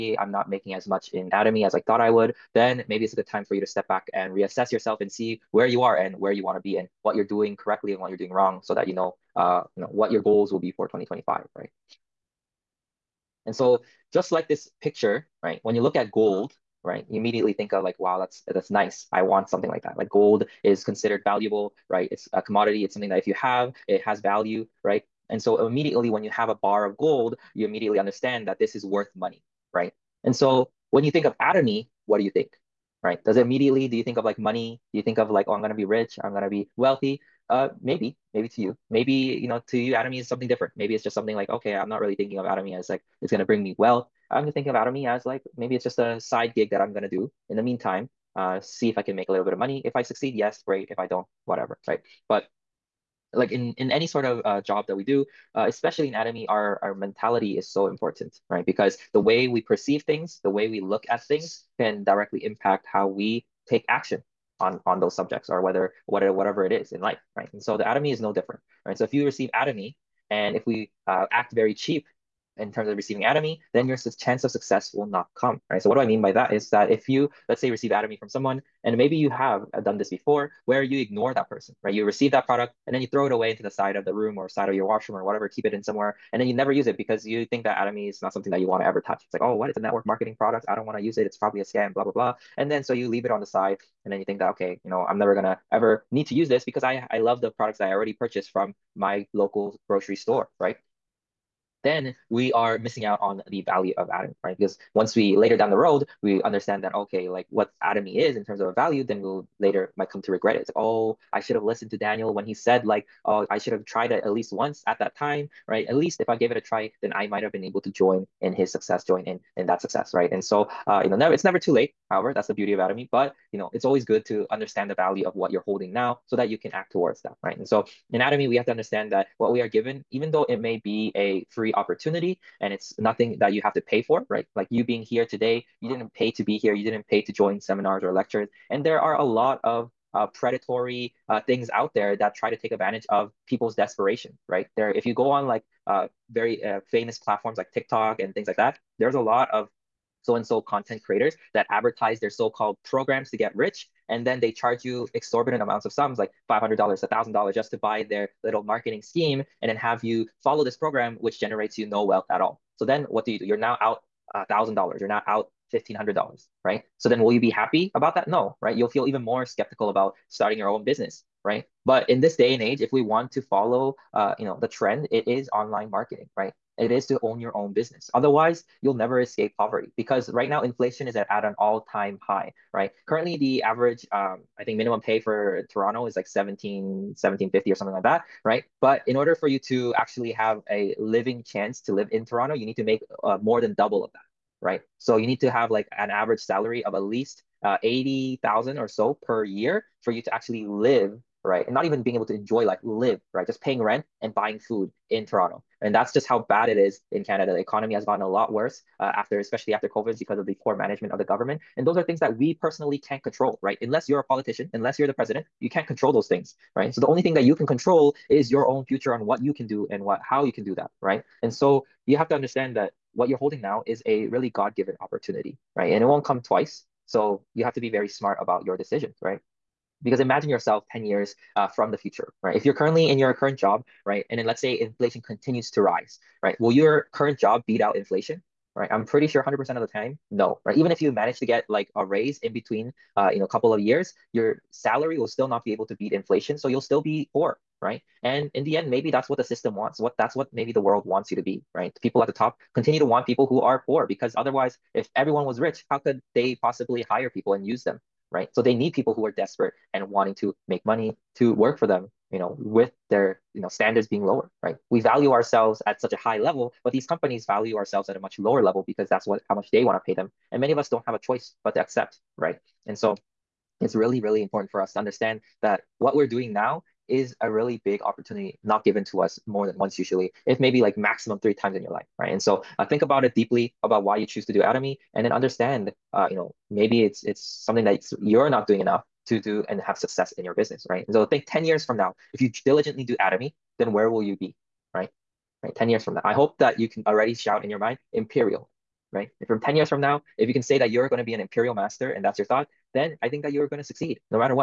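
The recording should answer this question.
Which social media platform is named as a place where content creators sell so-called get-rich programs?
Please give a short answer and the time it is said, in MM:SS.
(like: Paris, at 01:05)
TikTok, at 02:27.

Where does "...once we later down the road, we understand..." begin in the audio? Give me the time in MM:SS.
01:44.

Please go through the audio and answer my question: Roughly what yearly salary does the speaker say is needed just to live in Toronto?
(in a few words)
80,000.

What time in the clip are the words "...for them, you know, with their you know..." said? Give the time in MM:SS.
04:21.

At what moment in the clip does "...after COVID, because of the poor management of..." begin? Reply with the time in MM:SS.
03:29.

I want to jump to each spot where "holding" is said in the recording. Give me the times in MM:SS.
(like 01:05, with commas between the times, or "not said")
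02:05, 03:43.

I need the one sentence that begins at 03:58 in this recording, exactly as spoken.
I'm pretty sure 100% of the time, no, right?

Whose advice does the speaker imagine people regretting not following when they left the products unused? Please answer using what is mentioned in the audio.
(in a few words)
Daniel.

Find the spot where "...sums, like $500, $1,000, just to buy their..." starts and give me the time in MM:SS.
02:35.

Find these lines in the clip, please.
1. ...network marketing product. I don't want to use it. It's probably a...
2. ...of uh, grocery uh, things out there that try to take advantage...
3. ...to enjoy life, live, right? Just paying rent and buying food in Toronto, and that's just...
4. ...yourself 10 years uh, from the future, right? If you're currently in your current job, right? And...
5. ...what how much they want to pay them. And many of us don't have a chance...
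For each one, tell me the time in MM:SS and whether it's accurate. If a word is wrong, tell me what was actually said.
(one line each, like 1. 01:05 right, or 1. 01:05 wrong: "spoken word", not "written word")
1. 01:29 right
2. 02:19 wrong: "predatory", not "grocery"
3. 03:22 right
4. 03:50 right
5. 04:29 wrong: "choice", not "chance".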